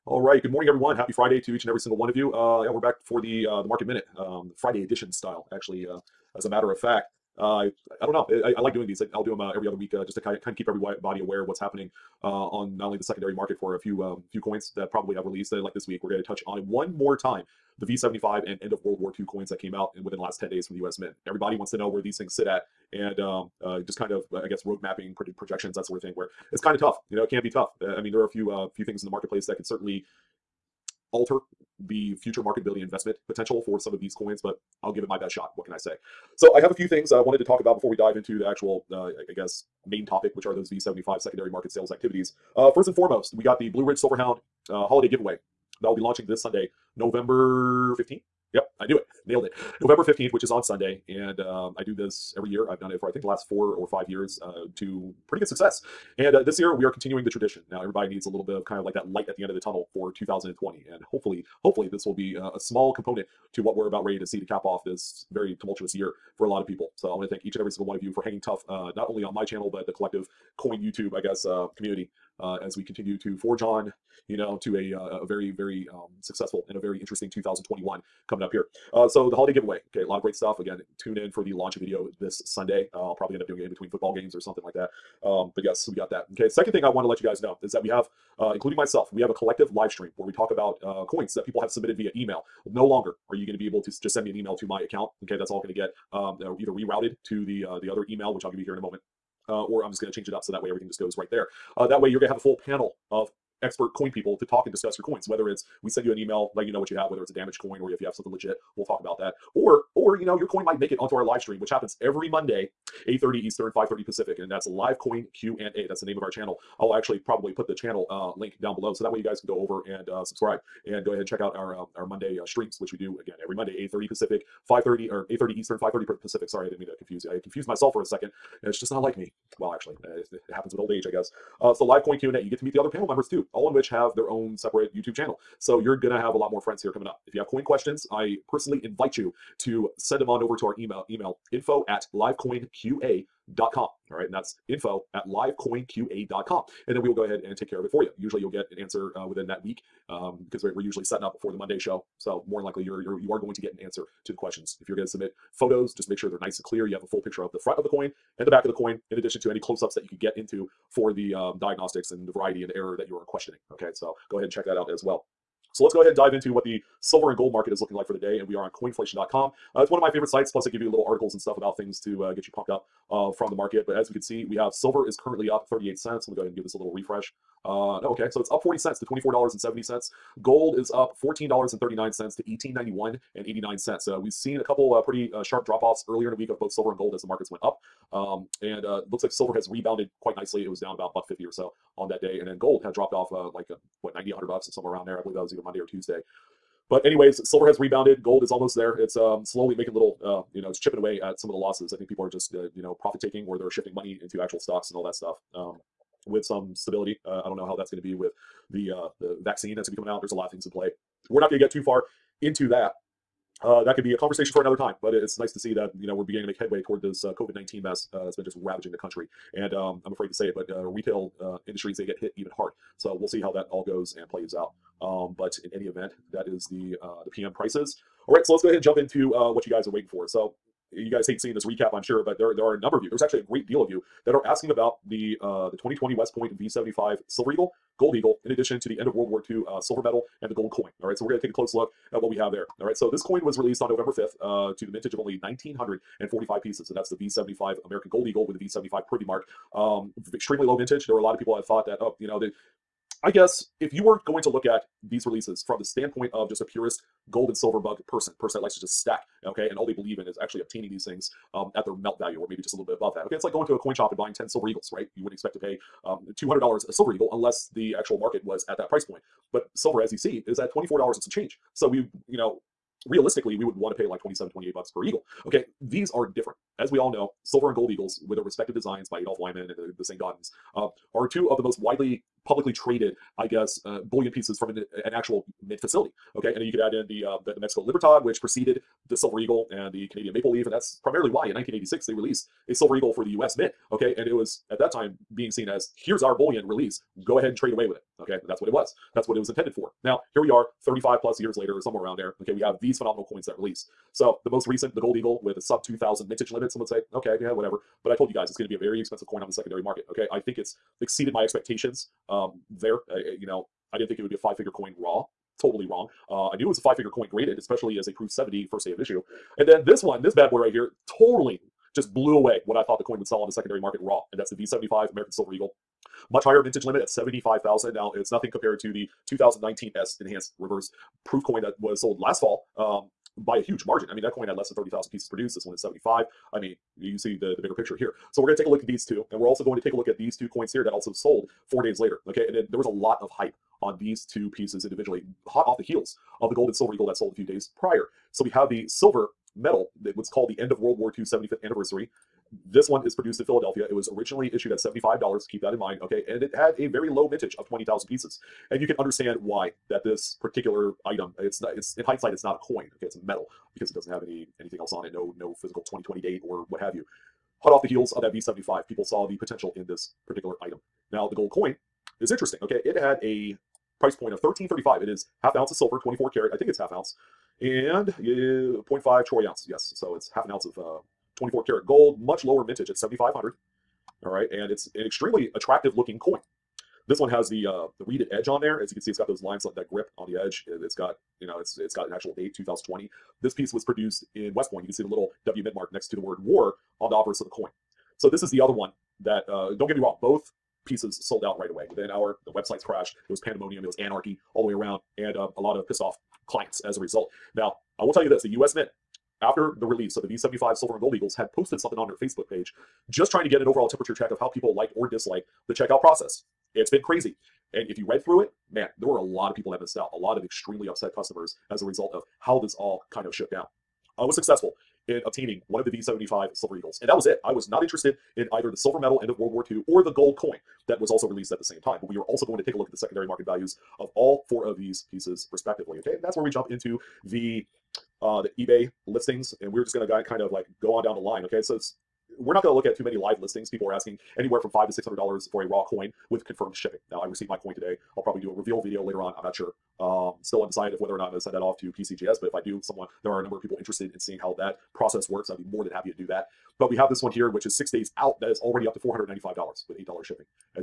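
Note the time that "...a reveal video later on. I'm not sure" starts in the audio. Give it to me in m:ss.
7:28.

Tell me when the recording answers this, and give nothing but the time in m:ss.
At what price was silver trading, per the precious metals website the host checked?
2:59.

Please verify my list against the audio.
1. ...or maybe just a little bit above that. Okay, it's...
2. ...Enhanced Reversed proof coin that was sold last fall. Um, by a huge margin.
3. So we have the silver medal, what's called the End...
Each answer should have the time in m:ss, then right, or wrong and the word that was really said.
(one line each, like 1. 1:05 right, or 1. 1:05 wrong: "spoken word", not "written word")
1. 4:22 right
2. 5:30 right
3. 5:48 right.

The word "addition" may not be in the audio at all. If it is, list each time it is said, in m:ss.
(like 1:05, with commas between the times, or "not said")
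2:39, 3:58.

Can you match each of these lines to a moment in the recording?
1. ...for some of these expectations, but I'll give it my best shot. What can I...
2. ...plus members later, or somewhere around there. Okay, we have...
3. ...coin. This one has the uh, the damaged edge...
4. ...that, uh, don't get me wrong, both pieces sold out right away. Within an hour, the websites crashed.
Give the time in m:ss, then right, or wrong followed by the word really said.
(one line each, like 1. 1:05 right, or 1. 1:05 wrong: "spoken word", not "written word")
1. 0:33 wrong: "coins", not "expectations"
2. 5:01 wrong: "years", not "members"
3. 6:26 wrong: "reeded", not "damaged"
4. 6:39 right.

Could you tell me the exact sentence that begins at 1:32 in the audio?
No longer are you going to be able to just send me an email to my account.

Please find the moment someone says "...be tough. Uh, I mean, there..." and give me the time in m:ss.
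0:27.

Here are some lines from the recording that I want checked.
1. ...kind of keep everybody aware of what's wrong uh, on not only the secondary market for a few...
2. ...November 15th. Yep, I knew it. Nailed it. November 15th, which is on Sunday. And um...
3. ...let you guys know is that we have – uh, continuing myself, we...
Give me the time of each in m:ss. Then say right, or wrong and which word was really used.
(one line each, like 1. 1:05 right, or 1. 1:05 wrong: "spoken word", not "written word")
1. 0:10 wrong: "happening", not "wrong"
2. 0:46 right
3. 1:27 wrong: "including", not "continuing".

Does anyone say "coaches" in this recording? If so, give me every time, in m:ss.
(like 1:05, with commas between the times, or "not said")
not said.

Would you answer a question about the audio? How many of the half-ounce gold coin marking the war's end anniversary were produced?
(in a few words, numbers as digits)
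7,500.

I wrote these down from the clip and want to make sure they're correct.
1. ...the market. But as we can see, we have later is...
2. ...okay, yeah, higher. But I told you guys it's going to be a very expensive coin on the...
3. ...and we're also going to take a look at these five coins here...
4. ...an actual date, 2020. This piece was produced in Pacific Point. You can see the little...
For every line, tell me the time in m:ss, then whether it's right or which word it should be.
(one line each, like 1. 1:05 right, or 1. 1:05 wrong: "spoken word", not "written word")
1. 2:53 wrong: "silver", not "later"
2. 5:07 wrong: "whatever", not "higher"
3. 5:39 wrong: "two", not "five"
4. 6:32 wrong: "West", not "Pacific".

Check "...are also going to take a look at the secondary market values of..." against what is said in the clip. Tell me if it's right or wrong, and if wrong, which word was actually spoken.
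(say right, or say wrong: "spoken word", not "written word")
right.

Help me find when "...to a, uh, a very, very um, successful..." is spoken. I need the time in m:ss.
1:14.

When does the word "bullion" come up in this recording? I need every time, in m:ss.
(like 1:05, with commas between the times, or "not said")
4:44, 4:56.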